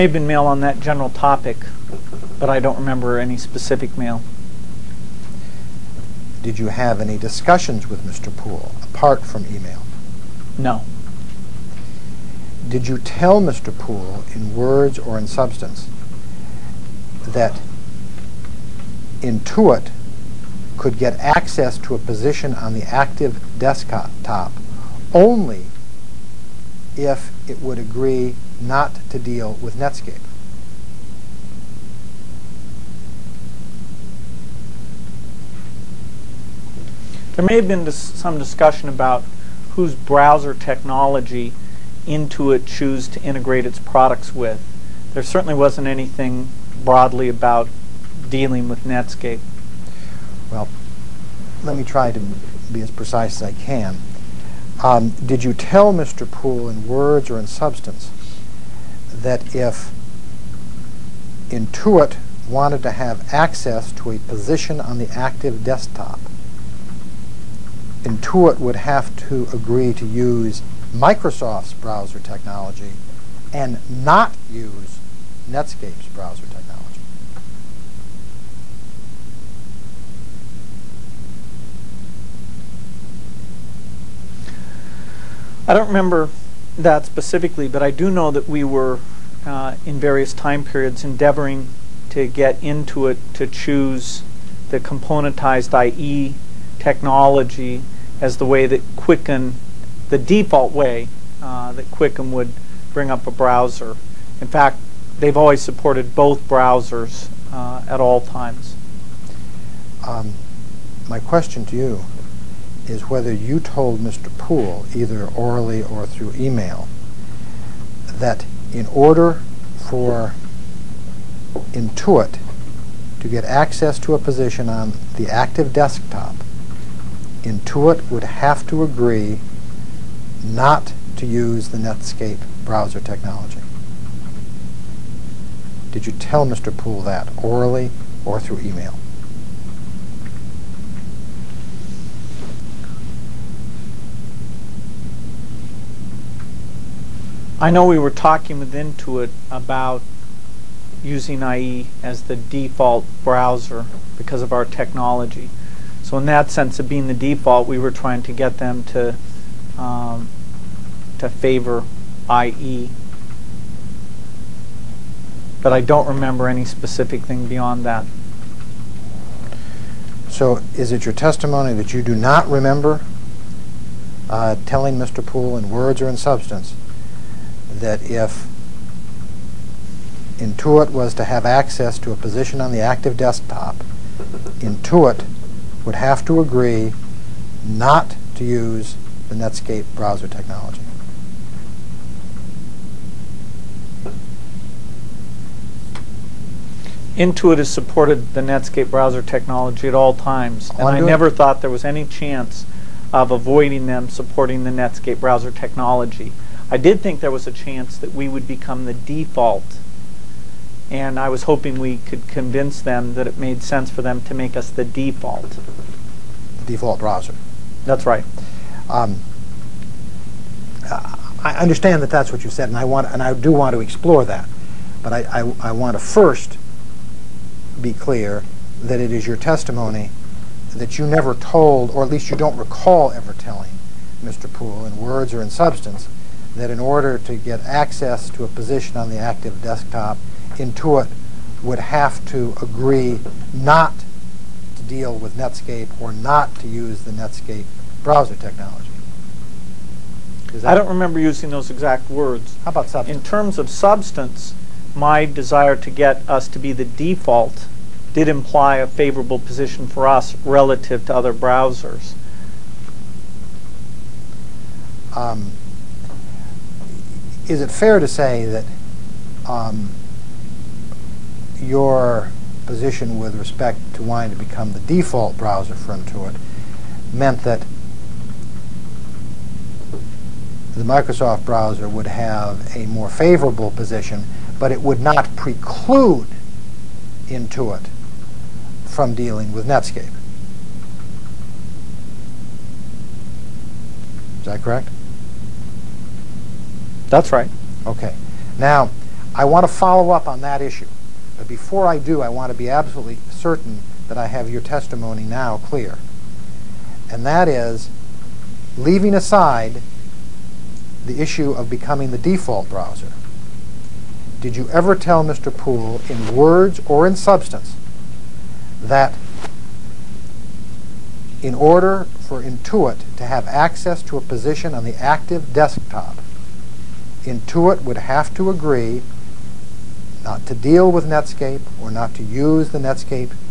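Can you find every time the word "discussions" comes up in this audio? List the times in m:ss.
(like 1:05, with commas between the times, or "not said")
0:07, 0:38.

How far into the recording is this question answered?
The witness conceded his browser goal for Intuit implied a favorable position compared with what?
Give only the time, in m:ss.
4:21.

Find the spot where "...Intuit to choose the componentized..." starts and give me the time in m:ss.
1:32.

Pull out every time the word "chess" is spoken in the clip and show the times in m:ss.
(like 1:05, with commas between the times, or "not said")
not said.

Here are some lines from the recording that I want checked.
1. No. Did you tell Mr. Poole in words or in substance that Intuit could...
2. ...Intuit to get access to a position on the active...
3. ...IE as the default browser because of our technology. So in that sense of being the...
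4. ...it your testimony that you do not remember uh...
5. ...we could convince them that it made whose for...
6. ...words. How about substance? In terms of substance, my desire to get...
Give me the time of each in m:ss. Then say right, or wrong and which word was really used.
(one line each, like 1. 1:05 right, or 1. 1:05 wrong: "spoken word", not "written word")
1. 0:10 right
2. 2:01 right
3. 2:31 right
4. 2:50 right
5. 3:31 wrong: "sense", not "whose"
6. 4:12 right.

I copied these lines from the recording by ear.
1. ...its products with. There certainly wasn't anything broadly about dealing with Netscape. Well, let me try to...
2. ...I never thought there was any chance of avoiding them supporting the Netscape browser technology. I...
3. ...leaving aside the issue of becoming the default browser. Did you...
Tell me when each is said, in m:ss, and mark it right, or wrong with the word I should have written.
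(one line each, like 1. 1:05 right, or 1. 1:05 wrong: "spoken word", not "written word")
1. 0:43 right
2. 3:20 right
3. 5:08 right.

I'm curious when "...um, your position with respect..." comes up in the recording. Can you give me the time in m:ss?
4:29.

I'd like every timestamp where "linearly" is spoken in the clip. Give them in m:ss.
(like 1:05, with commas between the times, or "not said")
not said.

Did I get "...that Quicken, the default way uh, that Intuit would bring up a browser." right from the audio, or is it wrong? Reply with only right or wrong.
wrong.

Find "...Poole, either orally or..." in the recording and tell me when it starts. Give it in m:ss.
1:54.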